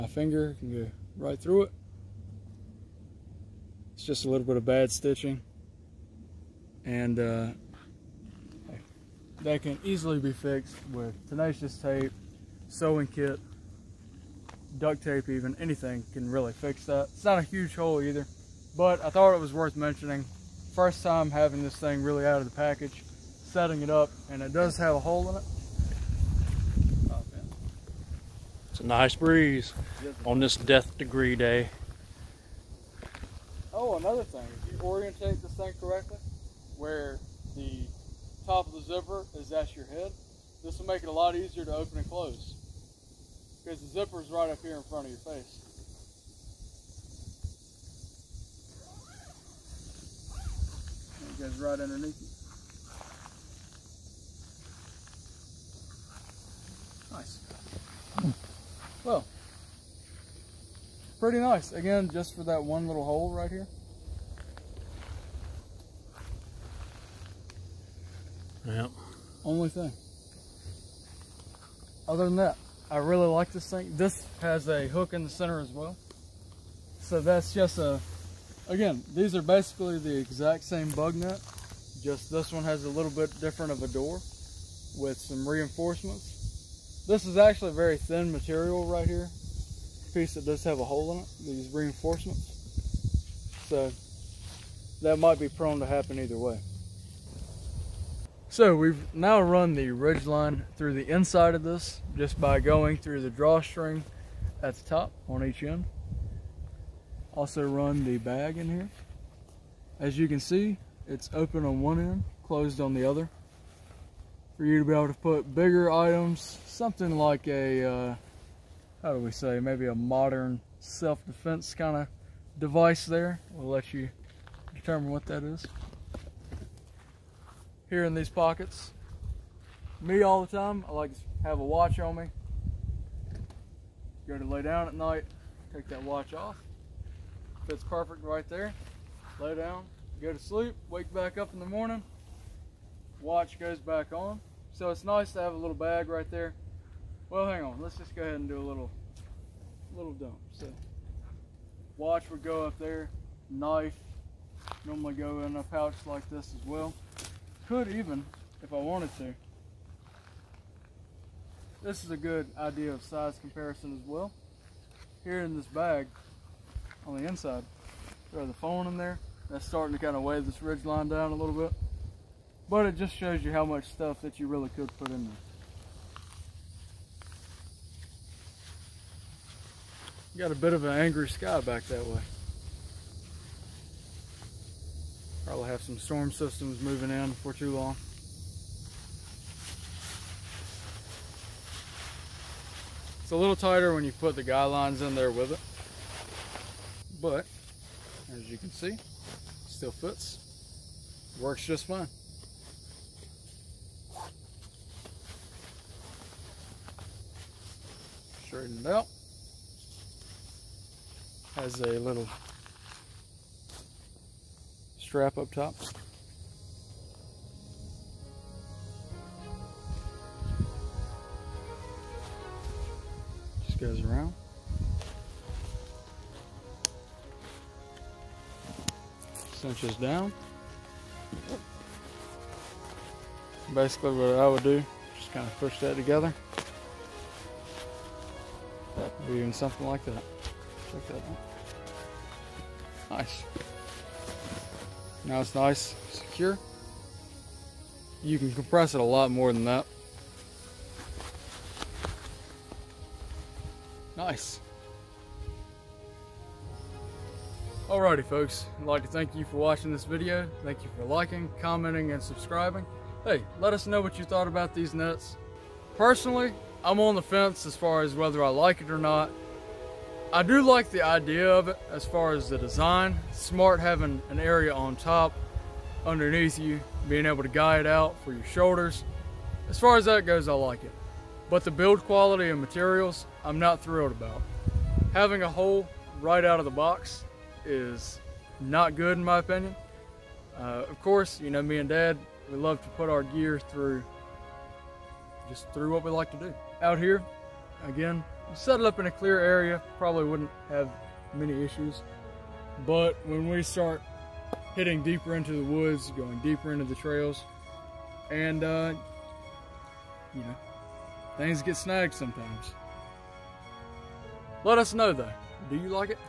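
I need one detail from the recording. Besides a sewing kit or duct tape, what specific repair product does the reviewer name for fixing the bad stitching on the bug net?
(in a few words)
Tenacious tape.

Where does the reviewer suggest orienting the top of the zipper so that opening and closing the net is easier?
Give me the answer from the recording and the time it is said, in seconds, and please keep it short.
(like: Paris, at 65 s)
At your head, at 39 s.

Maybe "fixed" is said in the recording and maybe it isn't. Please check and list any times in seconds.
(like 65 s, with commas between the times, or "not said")
10 s.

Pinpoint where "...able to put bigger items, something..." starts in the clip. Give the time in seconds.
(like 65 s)
114 s.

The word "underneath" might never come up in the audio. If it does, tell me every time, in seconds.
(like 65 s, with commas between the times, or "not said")
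51 s, 276 s.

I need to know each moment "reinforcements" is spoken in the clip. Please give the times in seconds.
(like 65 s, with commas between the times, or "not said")
85 s, 91 s.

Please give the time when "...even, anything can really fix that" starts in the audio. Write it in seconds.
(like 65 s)
15 s.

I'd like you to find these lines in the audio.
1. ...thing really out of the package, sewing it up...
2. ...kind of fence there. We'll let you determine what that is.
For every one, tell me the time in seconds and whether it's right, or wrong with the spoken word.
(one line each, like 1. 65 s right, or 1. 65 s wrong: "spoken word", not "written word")
1. 21 s wrong: "setting", not "sewing"
2. 121 s wrong: "device", not "fence".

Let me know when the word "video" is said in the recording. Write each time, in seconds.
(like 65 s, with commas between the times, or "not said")
260 s.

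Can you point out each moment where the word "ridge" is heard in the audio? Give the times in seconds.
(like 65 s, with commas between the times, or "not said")
99 s, 170 s.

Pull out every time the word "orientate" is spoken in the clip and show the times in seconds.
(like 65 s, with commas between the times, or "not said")
34 s.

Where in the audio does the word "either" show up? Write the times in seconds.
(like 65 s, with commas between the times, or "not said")
17 s, 96 s.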